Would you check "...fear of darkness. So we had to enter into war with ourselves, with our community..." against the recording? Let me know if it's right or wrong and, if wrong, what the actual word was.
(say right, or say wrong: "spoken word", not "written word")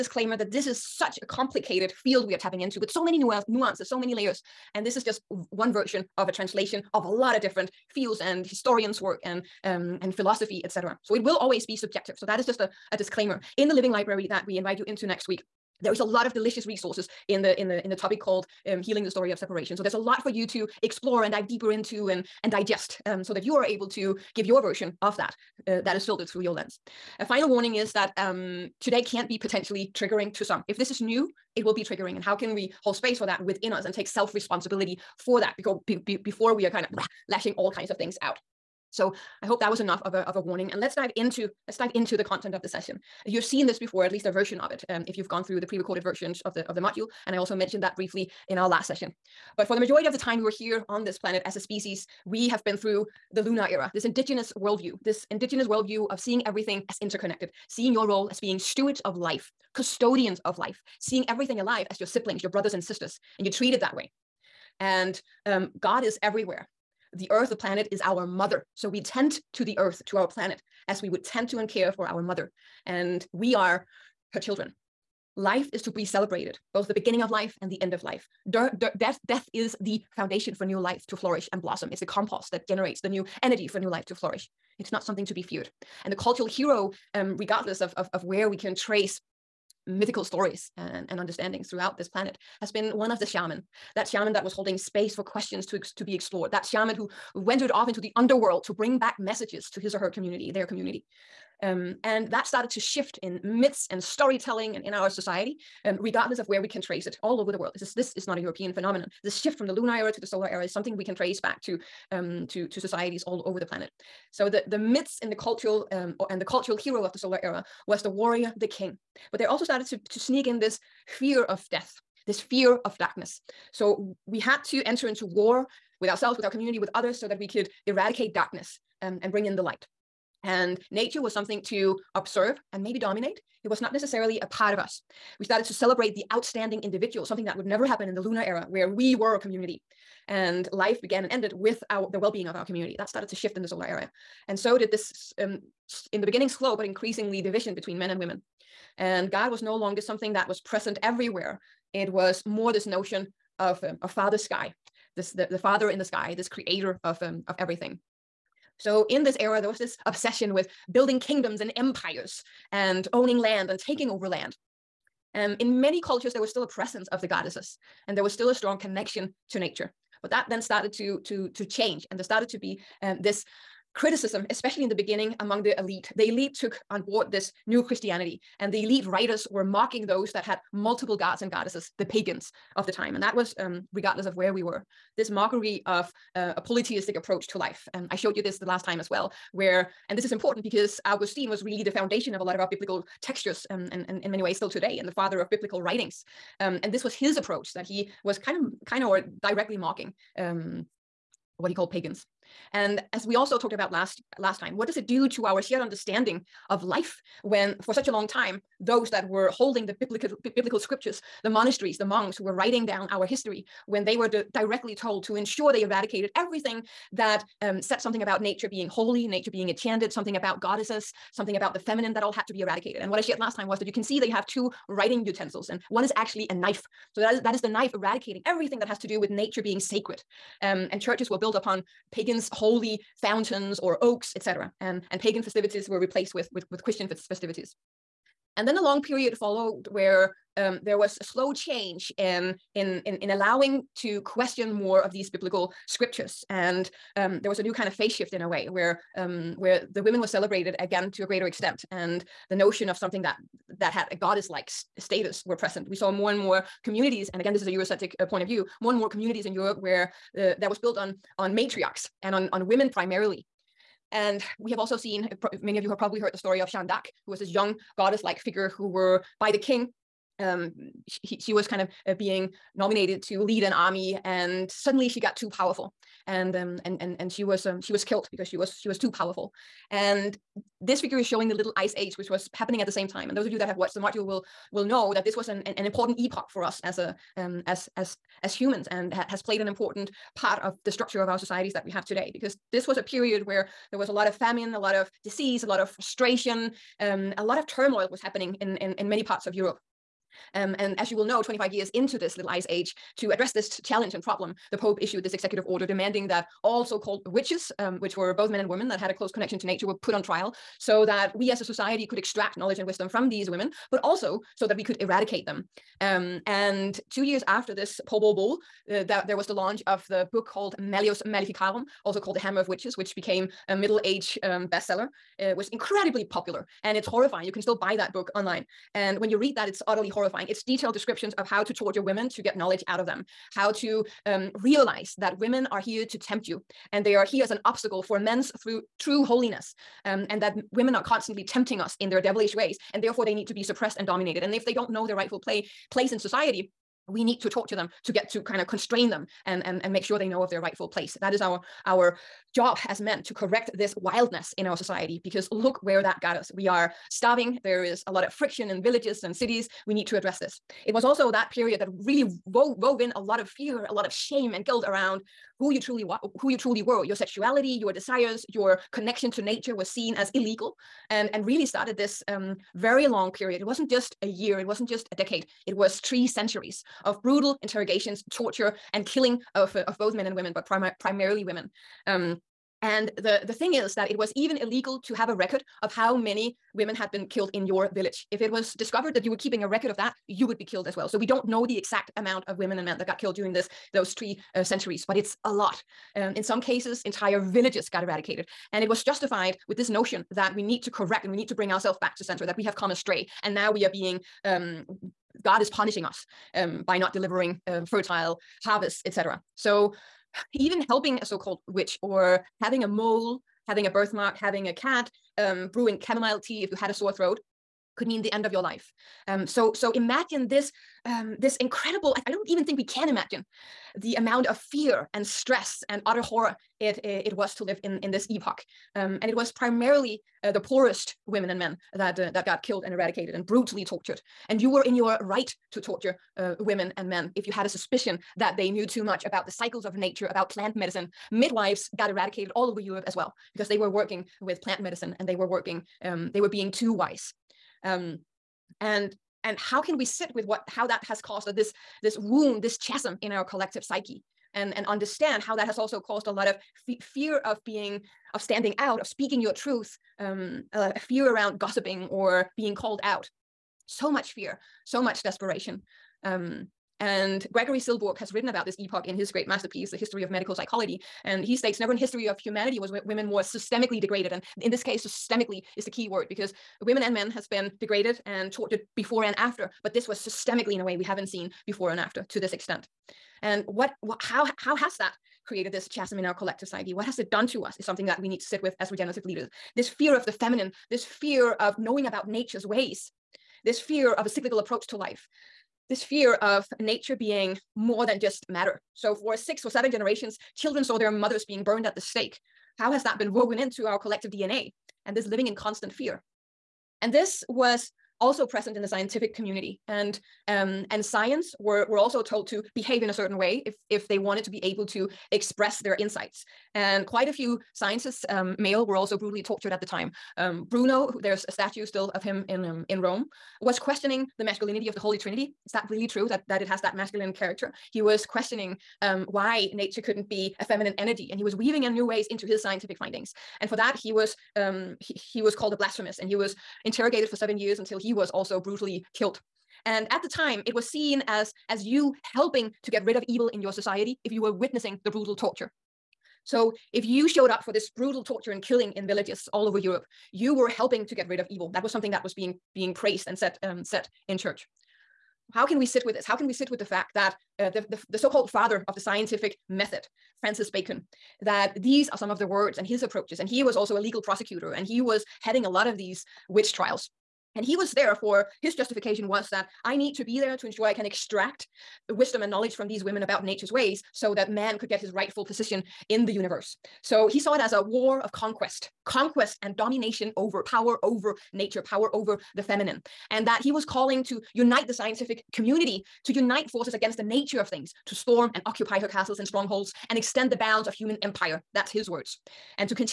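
right.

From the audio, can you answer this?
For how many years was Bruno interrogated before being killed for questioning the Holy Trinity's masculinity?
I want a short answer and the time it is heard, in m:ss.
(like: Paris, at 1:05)
7, at 8:57.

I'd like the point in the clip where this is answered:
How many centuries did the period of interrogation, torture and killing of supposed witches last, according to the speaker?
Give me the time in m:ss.
6:16.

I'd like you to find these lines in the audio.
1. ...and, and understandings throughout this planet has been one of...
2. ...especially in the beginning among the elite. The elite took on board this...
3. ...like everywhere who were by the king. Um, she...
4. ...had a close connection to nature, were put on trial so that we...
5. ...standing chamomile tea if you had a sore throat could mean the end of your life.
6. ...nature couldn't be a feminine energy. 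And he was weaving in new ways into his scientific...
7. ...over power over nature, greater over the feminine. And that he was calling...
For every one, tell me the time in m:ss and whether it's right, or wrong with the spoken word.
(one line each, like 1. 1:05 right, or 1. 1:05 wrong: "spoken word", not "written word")
1. 1:30 right
2. 2:54 right
3. 4:28 wrong: "figure", not "everywhere"
4. 5:08 right
5. 6:55 wrong: "brewing", not "standing"
6. 8:49 right
7. 9:40 wrong: "power", not "greater".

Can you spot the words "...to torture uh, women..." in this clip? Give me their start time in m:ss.
7:15.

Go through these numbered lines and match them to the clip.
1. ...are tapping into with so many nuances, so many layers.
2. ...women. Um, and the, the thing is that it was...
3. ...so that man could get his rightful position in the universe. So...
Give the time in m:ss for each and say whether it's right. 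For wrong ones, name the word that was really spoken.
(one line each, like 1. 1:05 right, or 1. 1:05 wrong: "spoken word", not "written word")
1. 0:02 right
2. 6:21 right
3. 9:34 right.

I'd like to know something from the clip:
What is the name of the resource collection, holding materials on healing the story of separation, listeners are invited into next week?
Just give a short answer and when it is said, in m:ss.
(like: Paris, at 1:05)
Living Library, at 0:13.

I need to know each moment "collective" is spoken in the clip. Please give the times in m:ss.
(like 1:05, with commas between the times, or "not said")
7:33, 8:06, 8:23.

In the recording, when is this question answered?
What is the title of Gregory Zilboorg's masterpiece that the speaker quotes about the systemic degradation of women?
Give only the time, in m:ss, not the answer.
7:49.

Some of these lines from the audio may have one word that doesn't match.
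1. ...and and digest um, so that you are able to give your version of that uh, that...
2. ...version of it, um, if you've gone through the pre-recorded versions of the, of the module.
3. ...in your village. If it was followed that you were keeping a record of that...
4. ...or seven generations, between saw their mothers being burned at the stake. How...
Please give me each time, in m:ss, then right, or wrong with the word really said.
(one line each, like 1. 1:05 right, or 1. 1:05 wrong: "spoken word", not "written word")
1. 0:22 right
2. 0:44 right
3. 6:27 wrong: "discovered", not "followed"
4. 8:19 wrong: "children", not "between".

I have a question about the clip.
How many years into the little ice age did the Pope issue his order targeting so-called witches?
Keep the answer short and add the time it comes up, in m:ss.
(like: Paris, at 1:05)
25, at 5:01.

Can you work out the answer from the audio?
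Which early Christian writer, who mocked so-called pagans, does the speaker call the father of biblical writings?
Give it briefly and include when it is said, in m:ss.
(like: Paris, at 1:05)
Augustine, at 3:11.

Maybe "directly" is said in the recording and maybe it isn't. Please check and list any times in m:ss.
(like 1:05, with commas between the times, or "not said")
3:19, 3:34.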